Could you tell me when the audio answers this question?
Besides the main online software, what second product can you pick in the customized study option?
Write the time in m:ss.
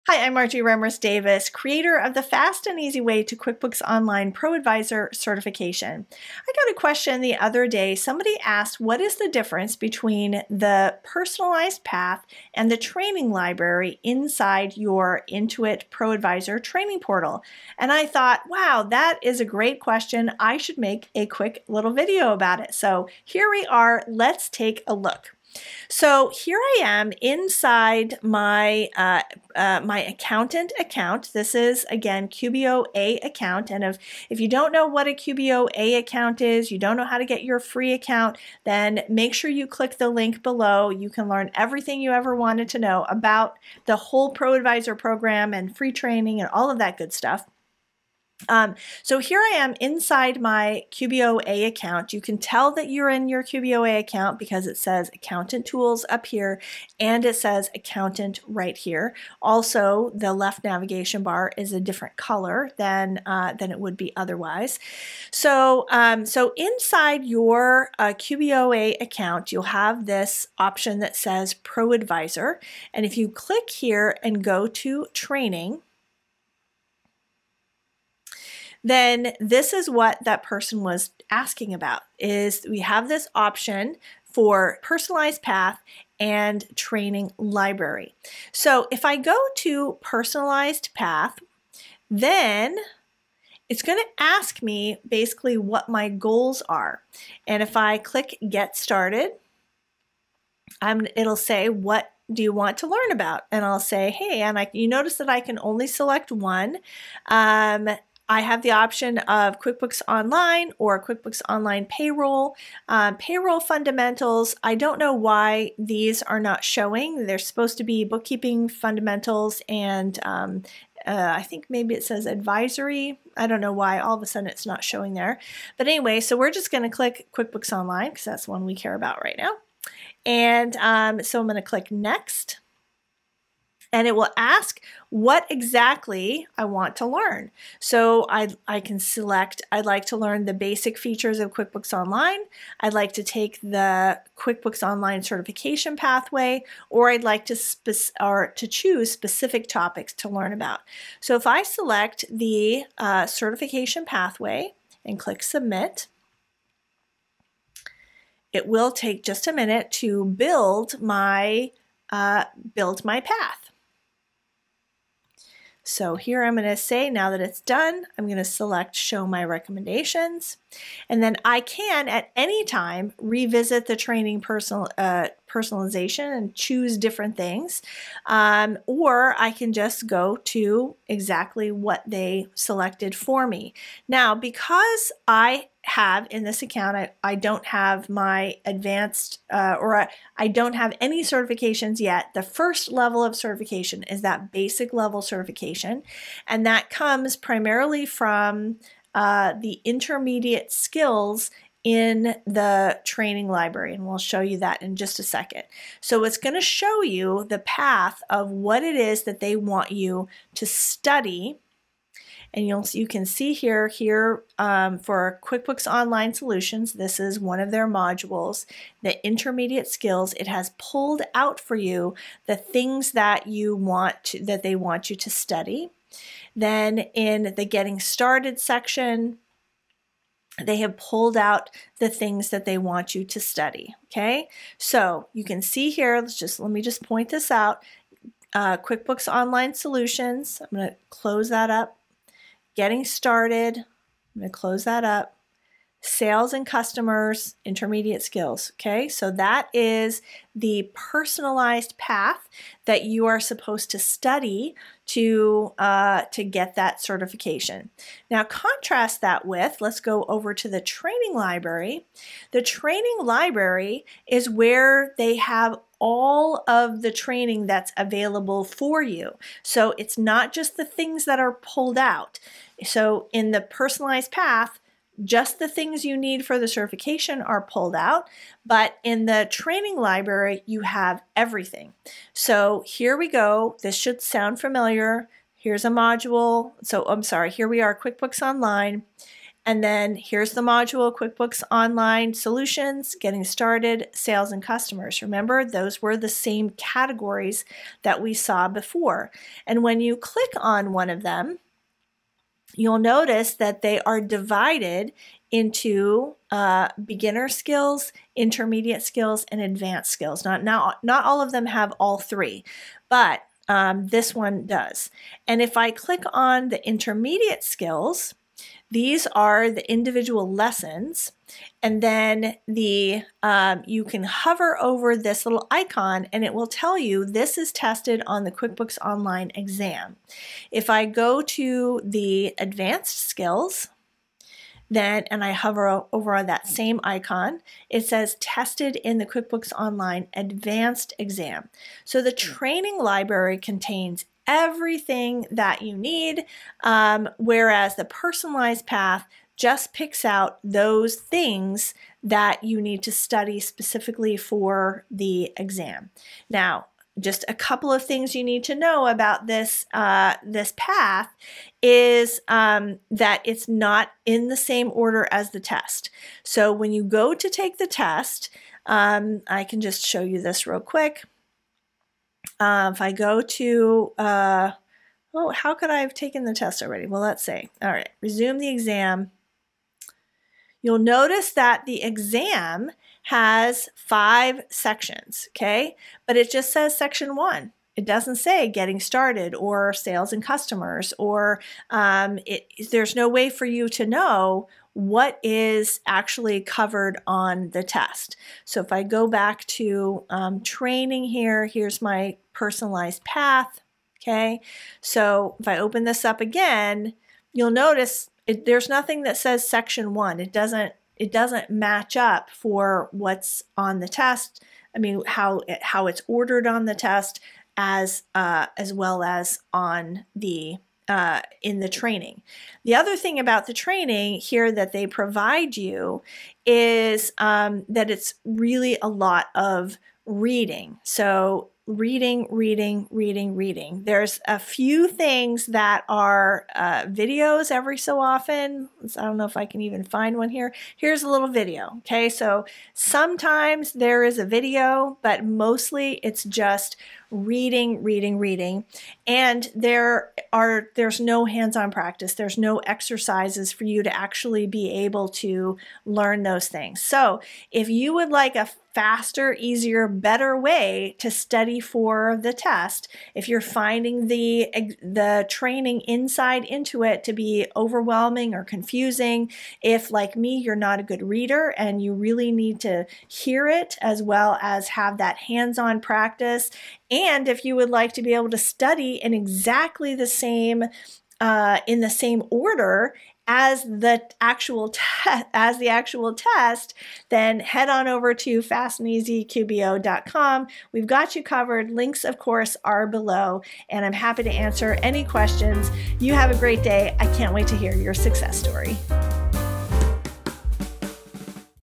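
1:51.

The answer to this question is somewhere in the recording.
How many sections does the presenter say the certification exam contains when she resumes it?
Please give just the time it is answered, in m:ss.
6:23.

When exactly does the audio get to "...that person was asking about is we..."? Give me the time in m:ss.
1:20.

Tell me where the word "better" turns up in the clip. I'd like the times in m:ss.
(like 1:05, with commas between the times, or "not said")
7:40.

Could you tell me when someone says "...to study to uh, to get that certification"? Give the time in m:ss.
4:13.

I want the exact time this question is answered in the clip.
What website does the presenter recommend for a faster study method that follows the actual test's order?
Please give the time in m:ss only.
8:08.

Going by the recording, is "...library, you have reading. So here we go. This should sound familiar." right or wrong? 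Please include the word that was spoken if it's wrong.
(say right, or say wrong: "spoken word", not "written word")
wrong: "everything", not "reading".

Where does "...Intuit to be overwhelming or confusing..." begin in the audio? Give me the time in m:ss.
7:46.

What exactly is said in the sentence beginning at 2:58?
Um, or I can just go to exactly what they selected for me.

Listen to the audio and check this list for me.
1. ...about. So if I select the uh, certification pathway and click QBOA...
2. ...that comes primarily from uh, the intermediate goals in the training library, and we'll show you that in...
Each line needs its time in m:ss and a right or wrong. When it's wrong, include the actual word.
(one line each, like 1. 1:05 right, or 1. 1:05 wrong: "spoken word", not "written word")
1. 2:30 wrong: "Submit", not "QBOA"
2. 3:16 wrong: "skills", not "goals".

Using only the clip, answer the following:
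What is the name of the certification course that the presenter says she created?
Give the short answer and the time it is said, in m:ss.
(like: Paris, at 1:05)
Fast and Easy Way to QuickBooks Online, at 0:02.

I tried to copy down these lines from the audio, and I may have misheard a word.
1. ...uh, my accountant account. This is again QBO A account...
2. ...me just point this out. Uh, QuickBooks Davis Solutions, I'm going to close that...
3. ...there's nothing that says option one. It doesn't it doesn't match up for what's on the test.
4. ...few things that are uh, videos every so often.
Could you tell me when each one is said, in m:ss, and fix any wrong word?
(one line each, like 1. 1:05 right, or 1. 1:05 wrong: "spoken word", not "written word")
1. 0:29 right
2. 3:56 wrong: "Online", not "Davis"
3. 6:48 wrong: "section", not "option"
4. 7:14 right.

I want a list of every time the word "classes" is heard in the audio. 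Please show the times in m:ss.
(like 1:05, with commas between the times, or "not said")
not said.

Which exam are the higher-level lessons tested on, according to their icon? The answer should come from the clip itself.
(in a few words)
QuickBooks Online Advanced Exam.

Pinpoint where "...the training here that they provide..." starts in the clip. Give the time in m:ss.
7:03.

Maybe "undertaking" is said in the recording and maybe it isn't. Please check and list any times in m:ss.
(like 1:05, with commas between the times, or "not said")
not said.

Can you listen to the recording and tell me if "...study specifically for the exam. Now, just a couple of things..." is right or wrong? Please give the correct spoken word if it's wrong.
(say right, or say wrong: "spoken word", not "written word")
right.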